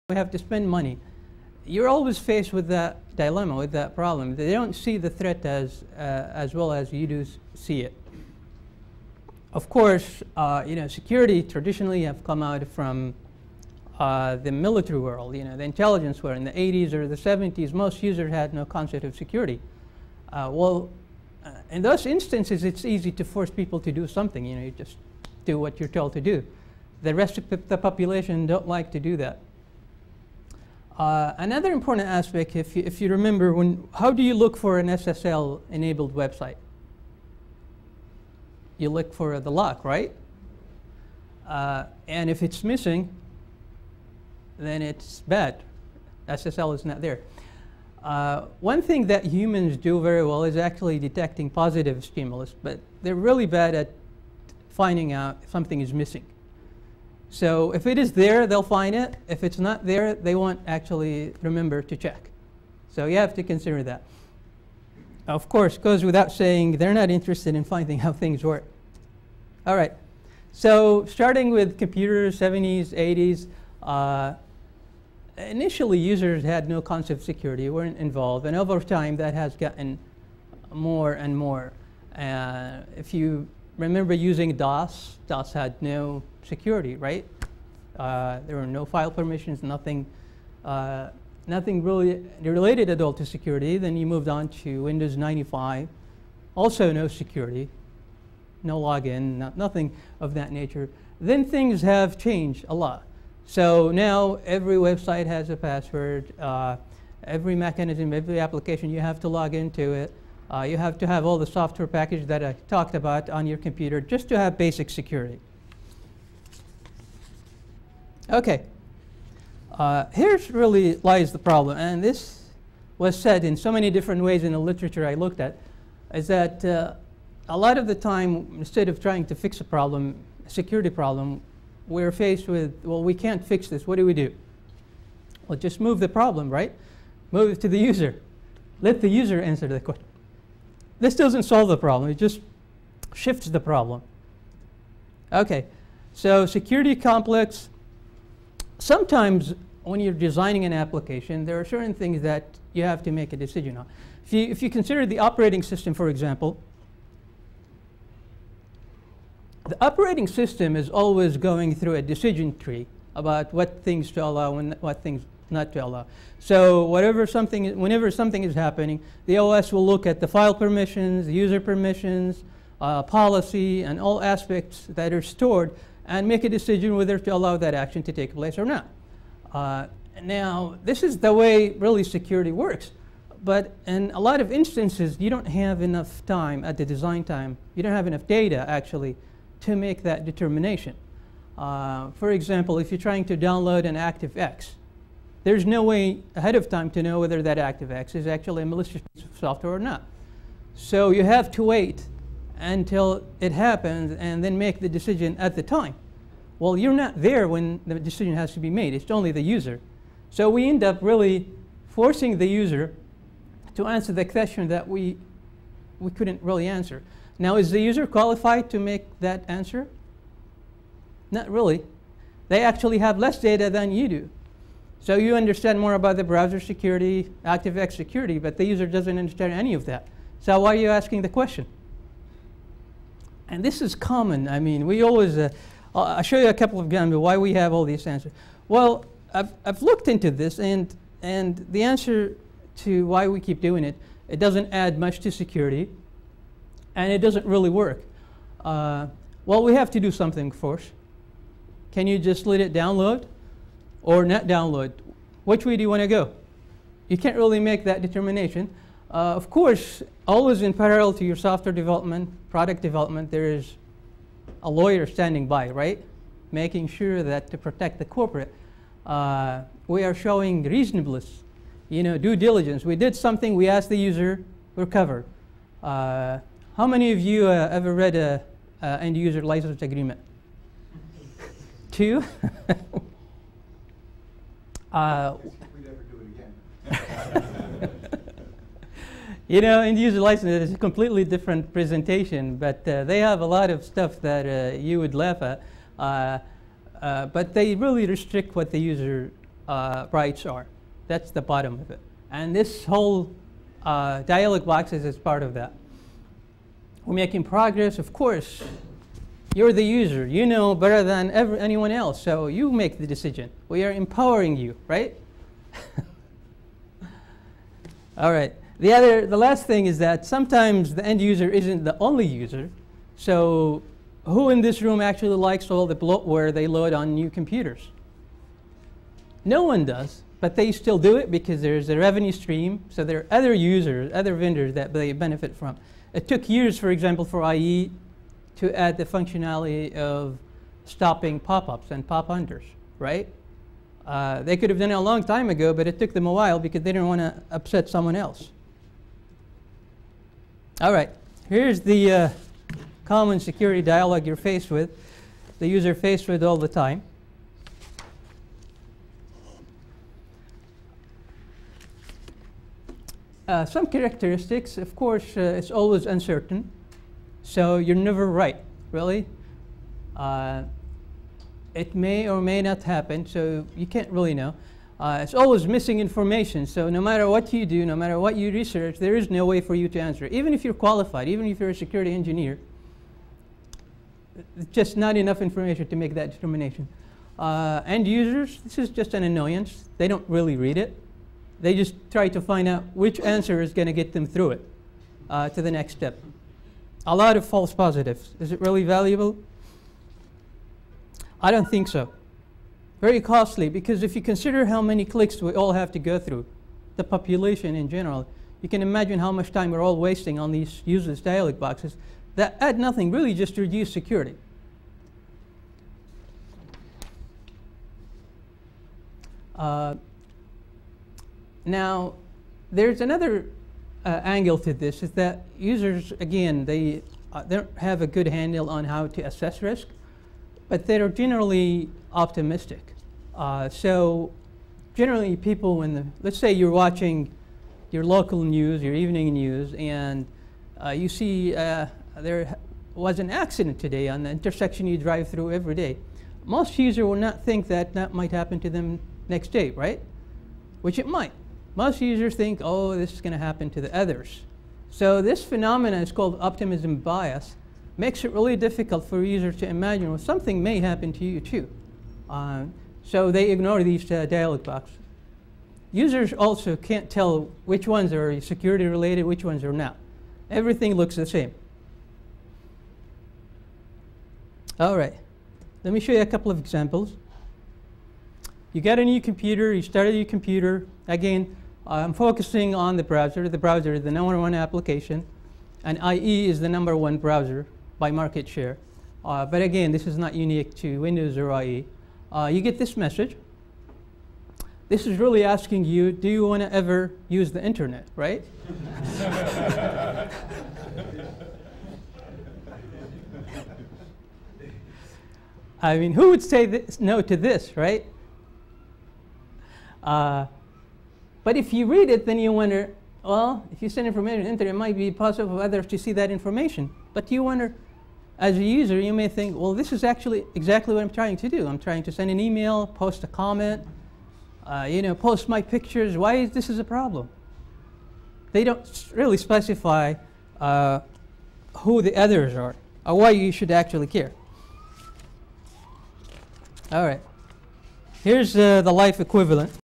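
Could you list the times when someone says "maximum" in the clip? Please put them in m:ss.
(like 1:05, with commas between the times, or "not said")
not said.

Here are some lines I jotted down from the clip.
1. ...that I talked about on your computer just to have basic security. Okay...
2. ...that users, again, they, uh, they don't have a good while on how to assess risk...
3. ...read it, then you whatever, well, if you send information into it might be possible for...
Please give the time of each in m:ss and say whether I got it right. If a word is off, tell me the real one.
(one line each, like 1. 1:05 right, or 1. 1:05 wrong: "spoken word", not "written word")
1. 1:52 right
2. 7:05 wrong: "handle", not "while"
3. 8:31 wrong: "wonder", not "whatever".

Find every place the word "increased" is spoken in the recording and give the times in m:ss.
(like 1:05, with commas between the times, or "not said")
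not said.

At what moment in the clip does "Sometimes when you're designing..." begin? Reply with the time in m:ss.
2:28.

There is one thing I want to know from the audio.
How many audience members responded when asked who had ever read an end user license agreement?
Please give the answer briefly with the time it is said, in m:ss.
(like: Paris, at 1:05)
2, at 4:41.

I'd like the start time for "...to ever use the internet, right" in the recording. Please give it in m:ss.
8:16.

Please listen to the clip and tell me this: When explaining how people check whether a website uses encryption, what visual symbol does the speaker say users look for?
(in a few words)
the lock.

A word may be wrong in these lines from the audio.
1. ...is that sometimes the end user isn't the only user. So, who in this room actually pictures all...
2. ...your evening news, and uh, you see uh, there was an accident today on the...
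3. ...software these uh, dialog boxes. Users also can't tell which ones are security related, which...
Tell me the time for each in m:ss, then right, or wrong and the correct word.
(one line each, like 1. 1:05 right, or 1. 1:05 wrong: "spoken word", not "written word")
1. 5:19 wrong: "likes", not "pictures"
2. 7:18 right
3. 7:43 wrong: "ignore", not "software".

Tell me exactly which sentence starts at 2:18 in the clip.
Let the user answer the question.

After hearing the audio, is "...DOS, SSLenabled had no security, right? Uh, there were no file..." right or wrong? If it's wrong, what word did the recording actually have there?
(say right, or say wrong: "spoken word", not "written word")
wrong: "DOS", not "SSLenabled".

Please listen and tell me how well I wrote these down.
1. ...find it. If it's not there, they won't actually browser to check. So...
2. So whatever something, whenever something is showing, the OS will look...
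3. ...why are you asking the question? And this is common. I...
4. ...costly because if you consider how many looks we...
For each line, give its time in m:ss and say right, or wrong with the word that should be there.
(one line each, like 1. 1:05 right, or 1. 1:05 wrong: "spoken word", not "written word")
1. 0:58 wrong: "remember", not "browser"
2. 2:46 wrong: "happening", not "showing"
3. 3:50 right
4. 6:43 wrong: "clicks", not "looks".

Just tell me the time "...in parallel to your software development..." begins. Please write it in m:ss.
4:20.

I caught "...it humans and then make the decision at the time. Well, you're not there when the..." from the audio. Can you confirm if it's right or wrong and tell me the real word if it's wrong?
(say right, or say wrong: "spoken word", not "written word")
wrong: "happens", not "humans".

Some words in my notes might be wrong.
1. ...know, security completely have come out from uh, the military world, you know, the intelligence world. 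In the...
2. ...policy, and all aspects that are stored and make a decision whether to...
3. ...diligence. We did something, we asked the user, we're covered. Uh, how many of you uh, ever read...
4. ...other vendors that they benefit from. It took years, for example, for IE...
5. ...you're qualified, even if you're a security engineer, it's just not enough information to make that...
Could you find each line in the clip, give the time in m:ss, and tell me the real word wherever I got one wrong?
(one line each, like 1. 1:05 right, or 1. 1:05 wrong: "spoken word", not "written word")
1. 0:10 wrong: "traditionally", not "completely"
2. 2:53 right
3. 4:32 right
4. 5:34 right
5. 6:20 right.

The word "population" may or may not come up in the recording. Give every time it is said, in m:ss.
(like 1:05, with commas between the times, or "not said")
0:27, 6:47.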